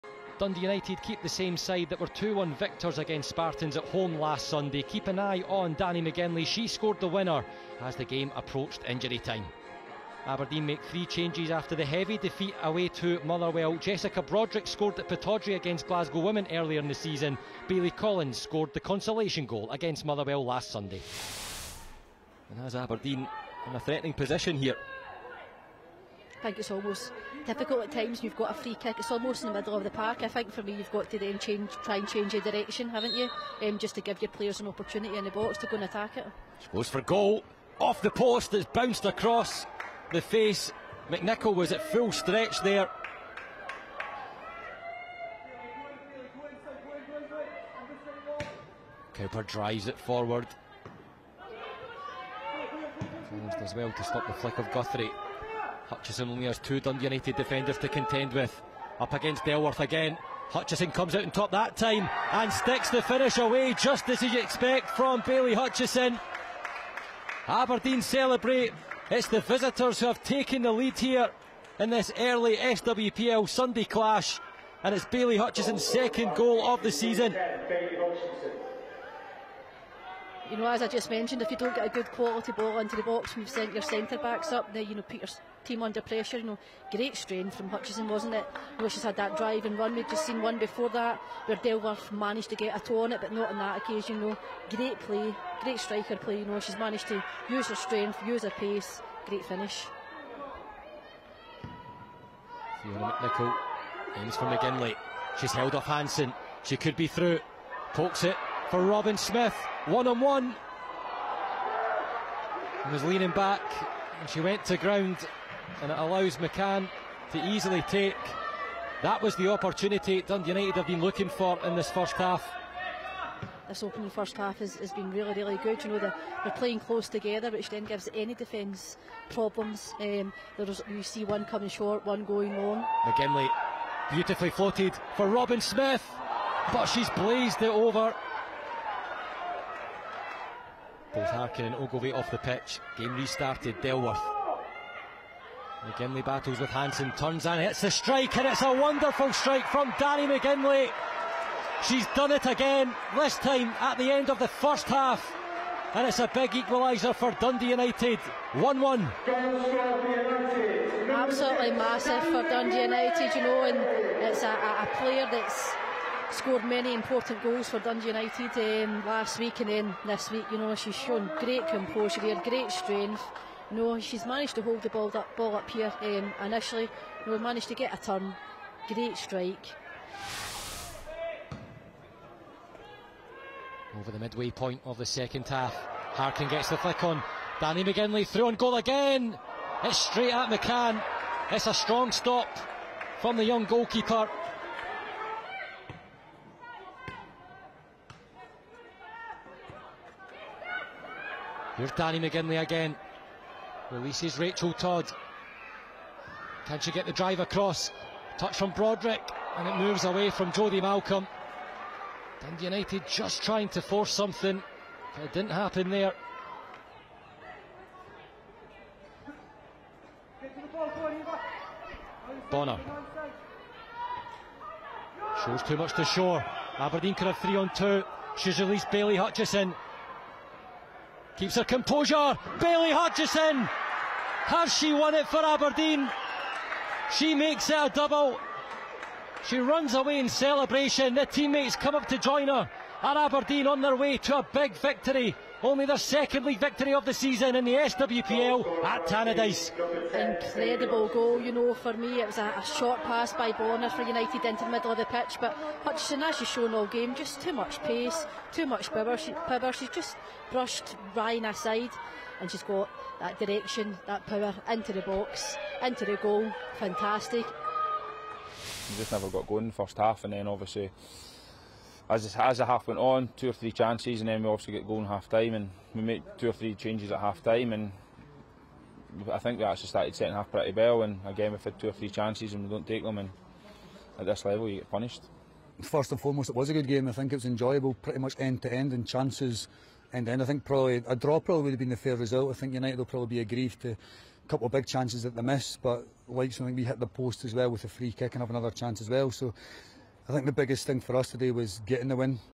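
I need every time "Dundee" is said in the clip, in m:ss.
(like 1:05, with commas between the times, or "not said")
0:00, 0:56, 2:00, 2:37, 2:42, 2:47, 3:32.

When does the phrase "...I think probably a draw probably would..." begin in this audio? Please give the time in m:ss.
4:50.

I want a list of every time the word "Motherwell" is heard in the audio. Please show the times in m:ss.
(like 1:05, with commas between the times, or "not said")
0:13, 0:20.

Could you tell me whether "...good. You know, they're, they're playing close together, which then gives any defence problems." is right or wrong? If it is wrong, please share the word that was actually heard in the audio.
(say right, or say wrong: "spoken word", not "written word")
right.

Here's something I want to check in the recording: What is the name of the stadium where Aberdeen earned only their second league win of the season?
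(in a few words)
Tannadice.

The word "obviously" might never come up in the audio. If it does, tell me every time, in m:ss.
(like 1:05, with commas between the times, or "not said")
4:30, 4:34.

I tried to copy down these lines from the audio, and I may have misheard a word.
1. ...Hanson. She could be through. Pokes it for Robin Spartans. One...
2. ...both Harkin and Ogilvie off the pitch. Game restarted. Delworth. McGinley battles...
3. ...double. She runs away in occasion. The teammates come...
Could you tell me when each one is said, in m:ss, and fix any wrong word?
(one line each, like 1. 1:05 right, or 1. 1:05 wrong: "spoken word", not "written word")
1. 1:45 wrong: "Smith", not "Spartans"
2. 2:21 right
3. 3:57 wrong: "celebration", not "occasion".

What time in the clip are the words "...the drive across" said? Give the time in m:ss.
3:27.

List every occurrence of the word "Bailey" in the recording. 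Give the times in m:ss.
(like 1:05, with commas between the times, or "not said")
0:17, 3:52.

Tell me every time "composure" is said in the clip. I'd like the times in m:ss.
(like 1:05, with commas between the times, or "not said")
2:51, 3:51.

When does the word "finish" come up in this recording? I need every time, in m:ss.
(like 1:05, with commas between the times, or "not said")
1:03, 1:39.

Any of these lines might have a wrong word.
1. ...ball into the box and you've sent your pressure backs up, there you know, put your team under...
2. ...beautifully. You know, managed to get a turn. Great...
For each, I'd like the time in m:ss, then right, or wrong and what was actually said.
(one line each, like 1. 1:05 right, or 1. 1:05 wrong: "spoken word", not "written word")
1. 1:22 wrong: "centre", not "pressure"
2. 2:56 wrong: "initially", not "beautifully".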